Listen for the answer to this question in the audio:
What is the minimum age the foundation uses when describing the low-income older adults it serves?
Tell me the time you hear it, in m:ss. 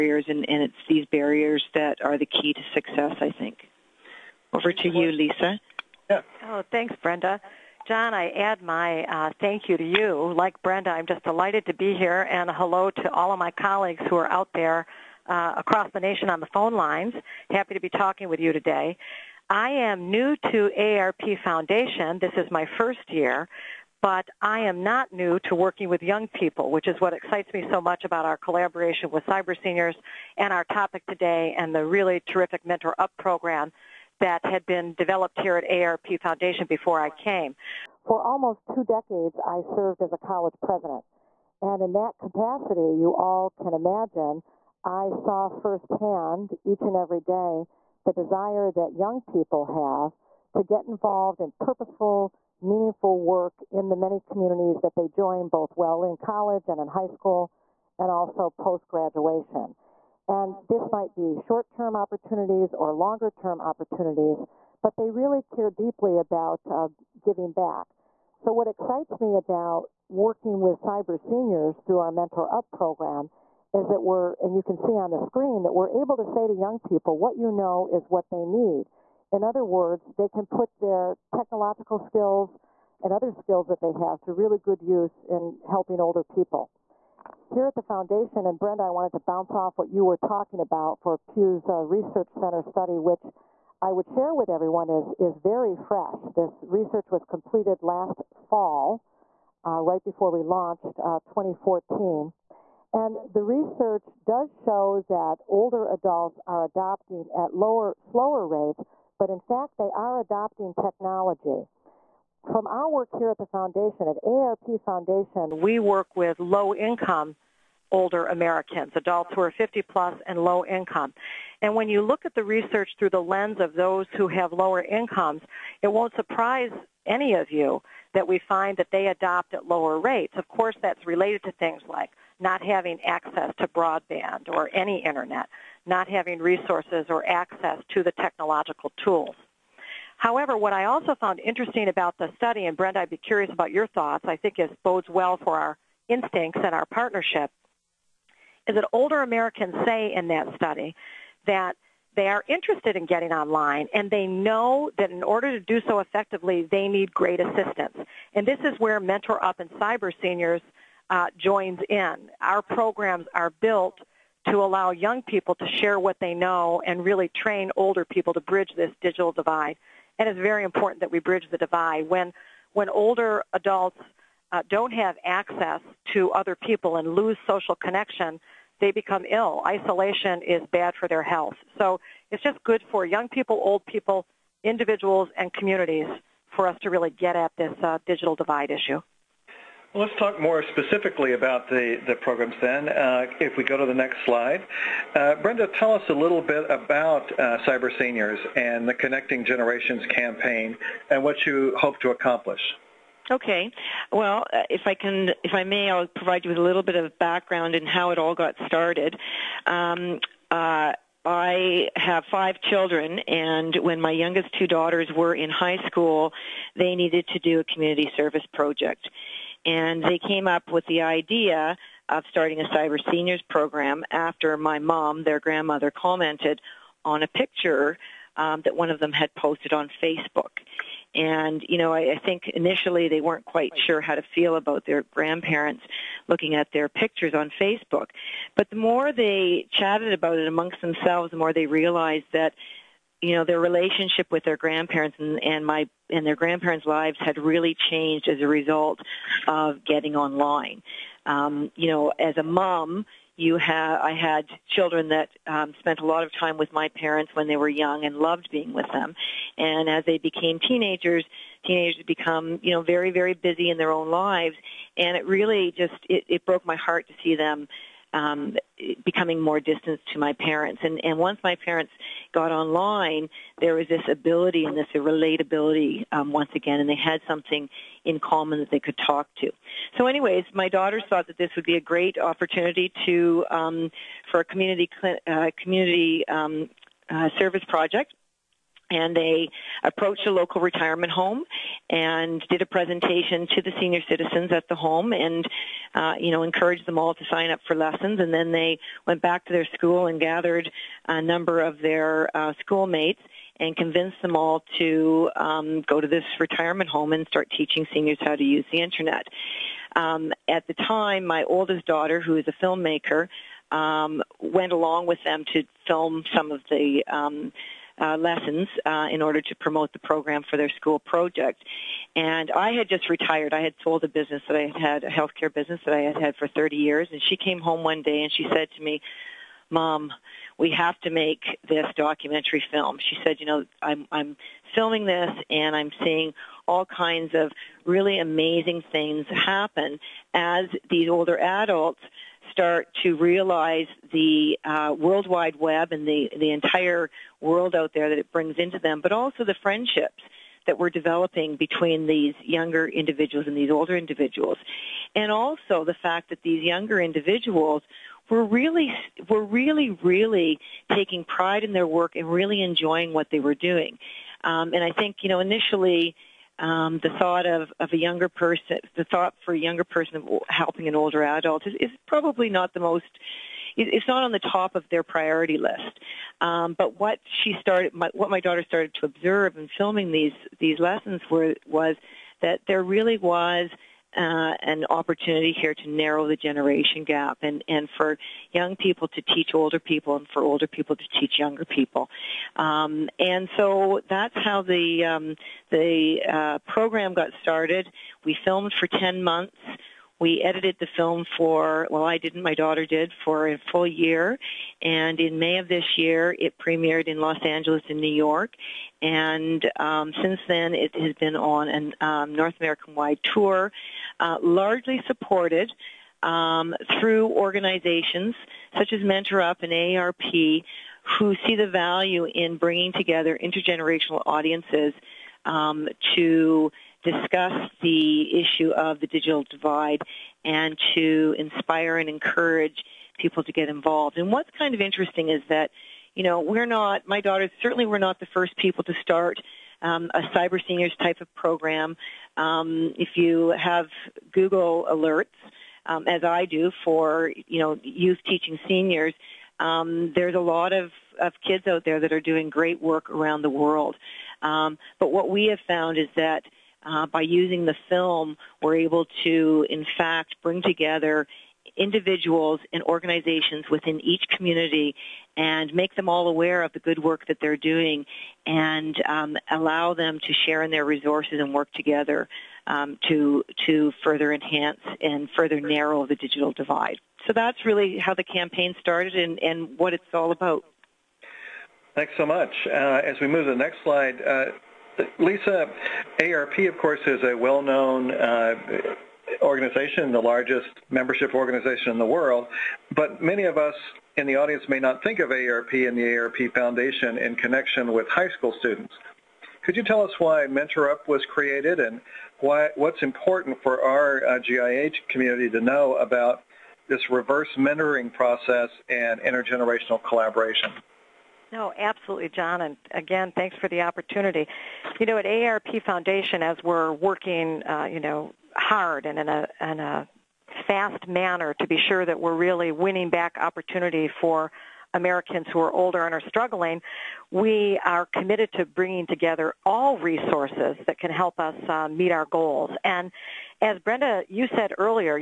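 1:59.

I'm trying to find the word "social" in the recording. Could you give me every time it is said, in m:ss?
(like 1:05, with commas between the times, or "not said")
2:57.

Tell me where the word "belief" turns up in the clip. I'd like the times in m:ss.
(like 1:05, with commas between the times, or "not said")
not said.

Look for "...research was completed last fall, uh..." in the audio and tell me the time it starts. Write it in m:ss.
1:36.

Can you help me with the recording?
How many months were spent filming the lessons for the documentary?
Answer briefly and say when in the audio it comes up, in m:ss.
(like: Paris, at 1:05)
10, at 6:38.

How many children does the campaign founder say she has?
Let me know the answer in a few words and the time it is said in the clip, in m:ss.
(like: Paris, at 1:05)
5, at 3:32.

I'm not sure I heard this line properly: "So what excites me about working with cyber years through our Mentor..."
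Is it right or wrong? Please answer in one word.
wrong.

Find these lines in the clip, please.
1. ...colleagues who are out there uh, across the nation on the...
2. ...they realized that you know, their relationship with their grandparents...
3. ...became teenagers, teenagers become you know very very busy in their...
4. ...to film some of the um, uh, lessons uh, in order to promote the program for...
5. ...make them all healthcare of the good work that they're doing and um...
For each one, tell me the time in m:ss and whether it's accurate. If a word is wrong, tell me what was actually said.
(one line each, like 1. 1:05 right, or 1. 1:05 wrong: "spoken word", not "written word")
1. 0:13 right
2. 4:01 right
3. 4:20 right
4. 5:15 right
5. 7:45 wrong: "aware", not "healthcare".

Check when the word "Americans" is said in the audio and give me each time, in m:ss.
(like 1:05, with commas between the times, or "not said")
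1:58, 2:29, 6:52, 8:44.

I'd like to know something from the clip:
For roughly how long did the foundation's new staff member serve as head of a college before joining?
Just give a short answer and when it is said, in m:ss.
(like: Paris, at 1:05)
almost two decades, at 0:38.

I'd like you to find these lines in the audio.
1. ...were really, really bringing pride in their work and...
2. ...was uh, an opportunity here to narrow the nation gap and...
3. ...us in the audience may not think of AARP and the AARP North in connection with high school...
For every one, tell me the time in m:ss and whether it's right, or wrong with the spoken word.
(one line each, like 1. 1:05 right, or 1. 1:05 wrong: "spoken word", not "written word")
1. 5:59 wrong: "taking", not "bringing"
2. 6:23 wrong: "generation", not "nation"
3. 8:13 wrong: "Foundation", not "North".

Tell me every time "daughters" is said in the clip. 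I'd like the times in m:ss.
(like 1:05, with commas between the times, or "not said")
3:34, 4:40, 5:11, 6:18, 6:42, 7:17.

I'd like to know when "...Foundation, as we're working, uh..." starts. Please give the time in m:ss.
8:35.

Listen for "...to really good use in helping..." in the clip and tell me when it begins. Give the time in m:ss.
1:24.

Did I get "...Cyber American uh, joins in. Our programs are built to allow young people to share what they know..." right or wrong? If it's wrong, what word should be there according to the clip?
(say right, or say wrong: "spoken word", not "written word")
wrong: "Seniors", not "American".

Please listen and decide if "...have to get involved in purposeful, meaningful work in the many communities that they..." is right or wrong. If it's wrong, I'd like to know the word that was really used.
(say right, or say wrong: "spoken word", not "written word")
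right.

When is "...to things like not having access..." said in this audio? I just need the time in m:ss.
2:11.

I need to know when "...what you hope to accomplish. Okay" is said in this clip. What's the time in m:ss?
3:21.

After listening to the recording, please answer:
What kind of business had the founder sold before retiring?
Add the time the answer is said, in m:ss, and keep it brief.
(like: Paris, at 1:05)
healthcare business, at 5:25.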